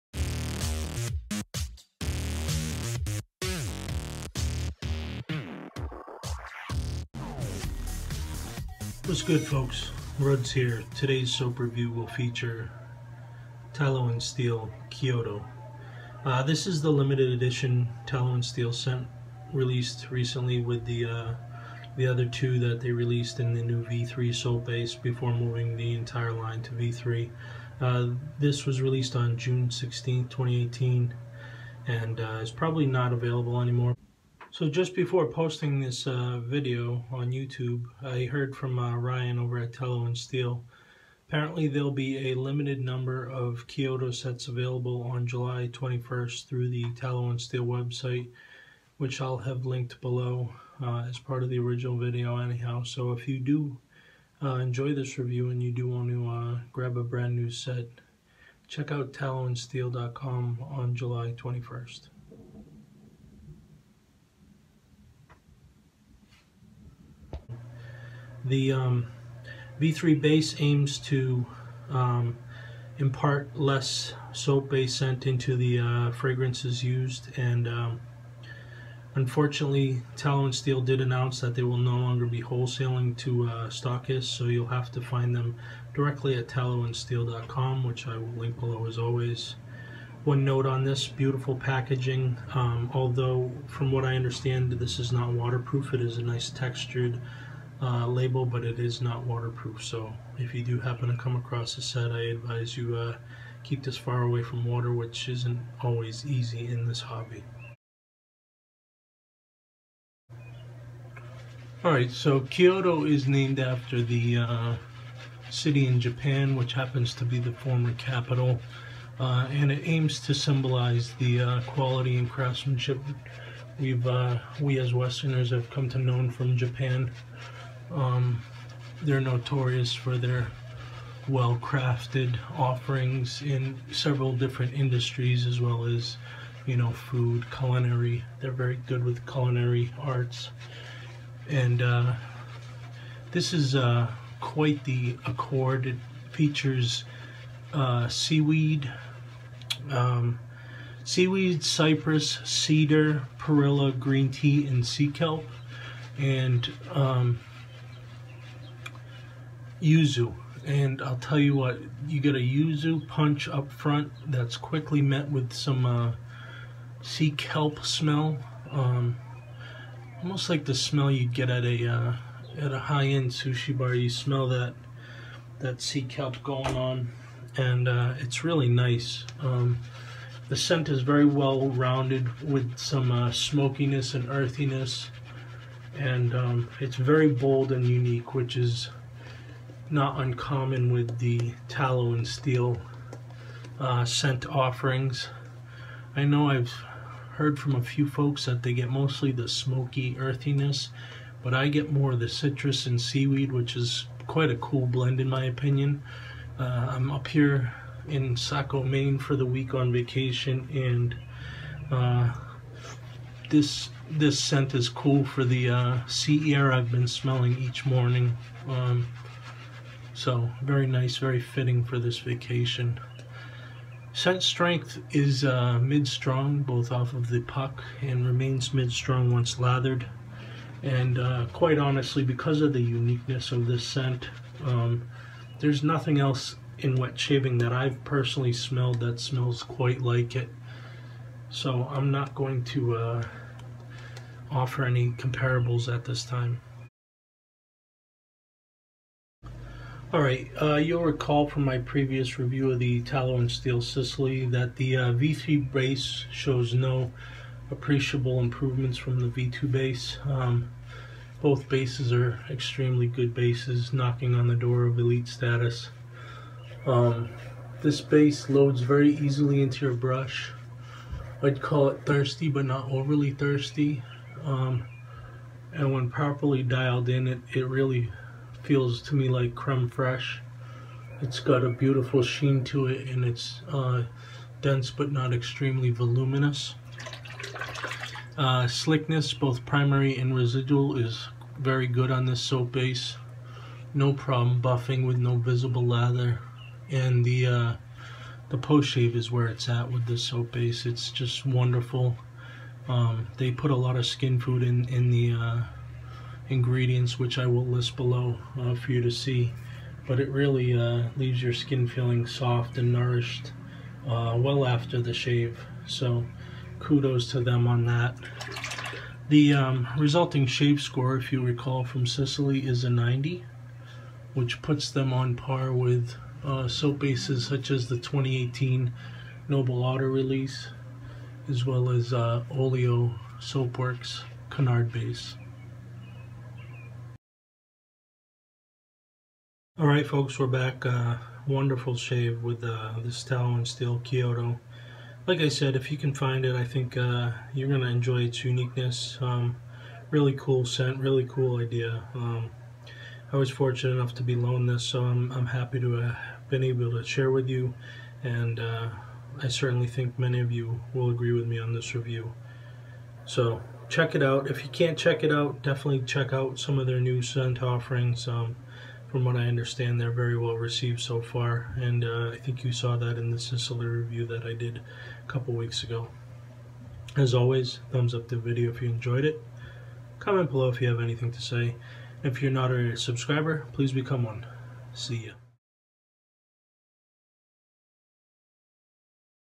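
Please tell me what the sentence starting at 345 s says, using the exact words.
Like I said, if you can find it, I think uh, you're going to enjoy its uniqueness.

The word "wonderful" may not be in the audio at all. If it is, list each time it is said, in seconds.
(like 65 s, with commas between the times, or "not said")
301 s, 341 s.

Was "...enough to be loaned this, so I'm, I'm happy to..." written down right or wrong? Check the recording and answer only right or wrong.
right.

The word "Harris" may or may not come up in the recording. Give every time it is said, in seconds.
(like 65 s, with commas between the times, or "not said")
not said.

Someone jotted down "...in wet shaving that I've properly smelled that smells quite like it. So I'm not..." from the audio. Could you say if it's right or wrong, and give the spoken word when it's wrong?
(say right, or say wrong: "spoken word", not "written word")
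wrong: "personally", not "properly".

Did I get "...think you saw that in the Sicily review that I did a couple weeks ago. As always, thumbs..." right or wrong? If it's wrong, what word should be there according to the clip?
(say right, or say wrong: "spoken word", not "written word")
right.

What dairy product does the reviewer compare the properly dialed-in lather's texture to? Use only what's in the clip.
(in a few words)
creme fraiche.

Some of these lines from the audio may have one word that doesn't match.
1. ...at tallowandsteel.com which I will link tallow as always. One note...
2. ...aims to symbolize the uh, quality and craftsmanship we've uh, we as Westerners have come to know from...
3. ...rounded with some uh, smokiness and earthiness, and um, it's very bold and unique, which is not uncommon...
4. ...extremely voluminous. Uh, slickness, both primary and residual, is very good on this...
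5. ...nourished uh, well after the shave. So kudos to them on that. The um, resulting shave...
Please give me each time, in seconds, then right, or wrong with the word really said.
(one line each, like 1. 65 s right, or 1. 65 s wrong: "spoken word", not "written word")
1. 86 s wrong: "below", not "tallow"
2. 119 s right
3. 181 s right
4. 285 s right
5. 312 s right.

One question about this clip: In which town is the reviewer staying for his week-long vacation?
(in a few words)
Saco, Maine.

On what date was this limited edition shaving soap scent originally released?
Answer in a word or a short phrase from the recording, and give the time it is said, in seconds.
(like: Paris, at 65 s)
June 16, 2018, at 29 s.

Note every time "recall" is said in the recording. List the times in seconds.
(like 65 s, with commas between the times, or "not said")
251 s, 321 s.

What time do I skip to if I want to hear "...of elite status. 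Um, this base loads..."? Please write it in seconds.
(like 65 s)
264 s.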